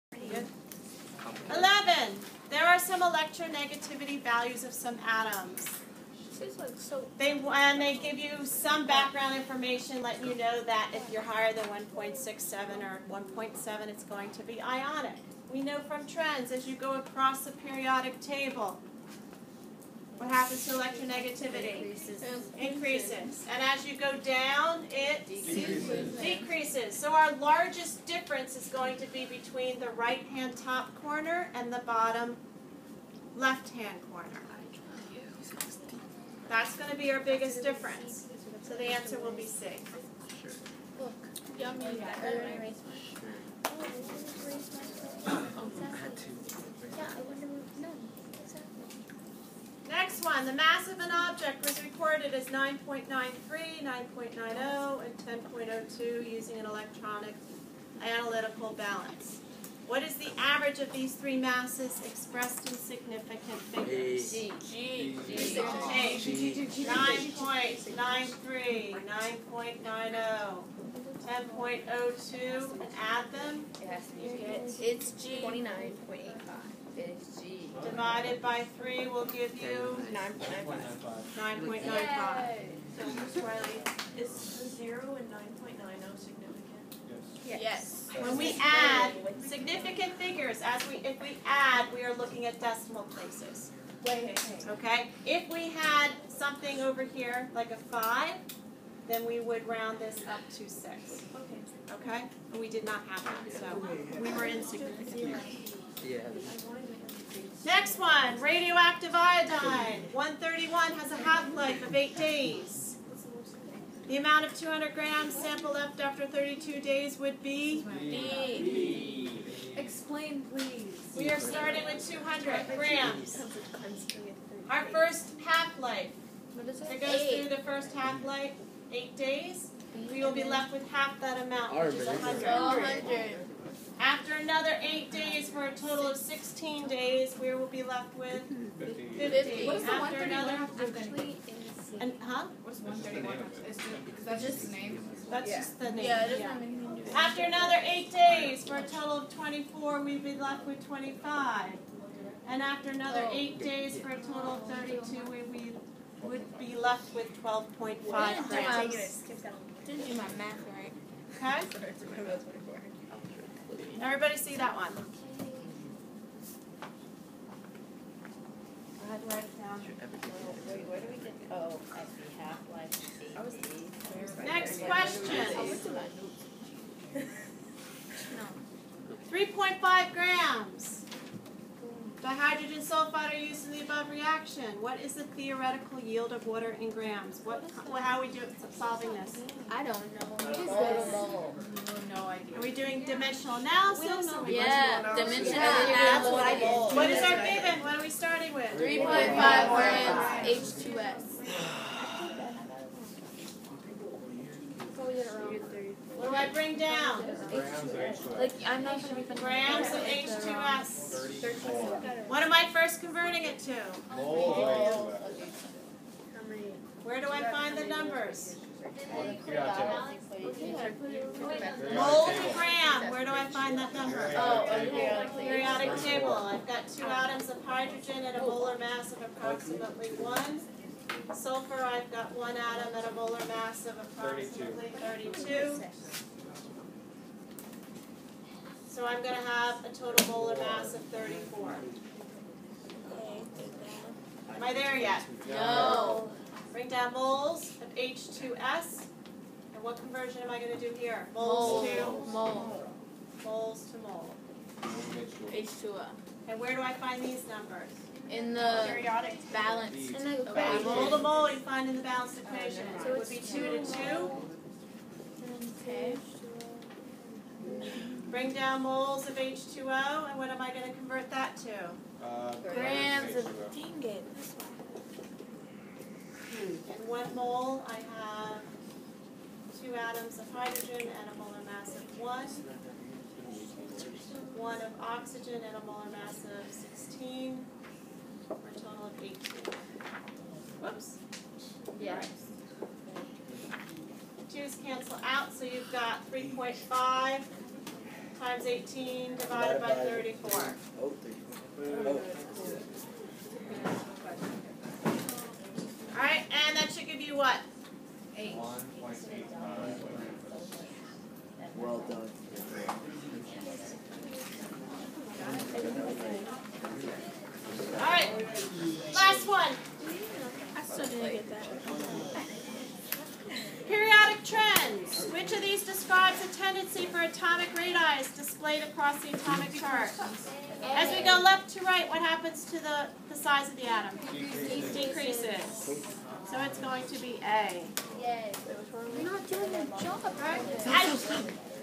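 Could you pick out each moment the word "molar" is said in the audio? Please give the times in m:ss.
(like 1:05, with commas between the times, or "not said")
3:48, 3:53, 4:00, 4:41, 4:45.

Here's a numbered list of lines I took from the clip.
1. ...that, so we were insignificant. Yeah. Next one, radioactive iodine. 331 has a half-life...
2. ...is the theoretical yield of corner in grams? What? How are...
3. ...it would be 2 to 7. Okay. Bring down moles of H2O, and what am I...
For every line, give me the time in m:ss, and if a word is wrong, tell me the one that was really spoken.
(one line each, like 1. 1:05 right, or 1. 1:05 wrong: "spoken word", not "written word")
1. 1:43 wrong: "131", not "331"
2. 3:05 wrong: "water", not "corner"
3. 4:23 wrong: "2", not "7".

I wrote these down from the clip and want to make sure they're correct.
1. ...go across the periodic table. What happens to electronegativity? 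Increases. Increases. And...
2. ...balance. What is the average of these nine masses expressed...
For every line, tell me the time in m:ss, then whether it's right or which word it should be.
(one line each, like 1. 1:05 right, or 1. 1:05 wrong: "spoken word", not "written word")
1. 0:16 right
2. 0:58 wrong: "three", not "nine".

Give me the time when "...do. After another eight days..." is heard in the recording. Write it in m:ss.
2:27.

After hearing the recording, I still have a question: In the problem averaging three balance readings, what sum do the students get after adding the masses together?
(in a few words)
29.85.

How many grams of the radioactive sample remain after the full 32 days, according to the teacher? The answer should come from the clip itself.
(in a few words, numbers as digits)
12.5 grams.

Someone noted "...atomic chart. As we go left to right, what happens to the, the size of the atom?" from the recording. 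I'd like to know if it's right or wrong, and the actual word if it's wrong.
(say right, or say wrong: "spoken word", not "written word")
right.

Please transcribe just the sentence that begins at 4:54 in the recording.
Twos cancel out, so you've got three point five times eighteen divided by thirty-four.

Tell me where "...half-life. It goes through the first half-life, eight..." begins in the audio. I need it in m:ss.
2:05.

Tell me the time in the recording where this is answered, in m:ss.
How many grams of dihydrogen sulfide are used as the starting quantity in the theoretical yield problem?
3:18.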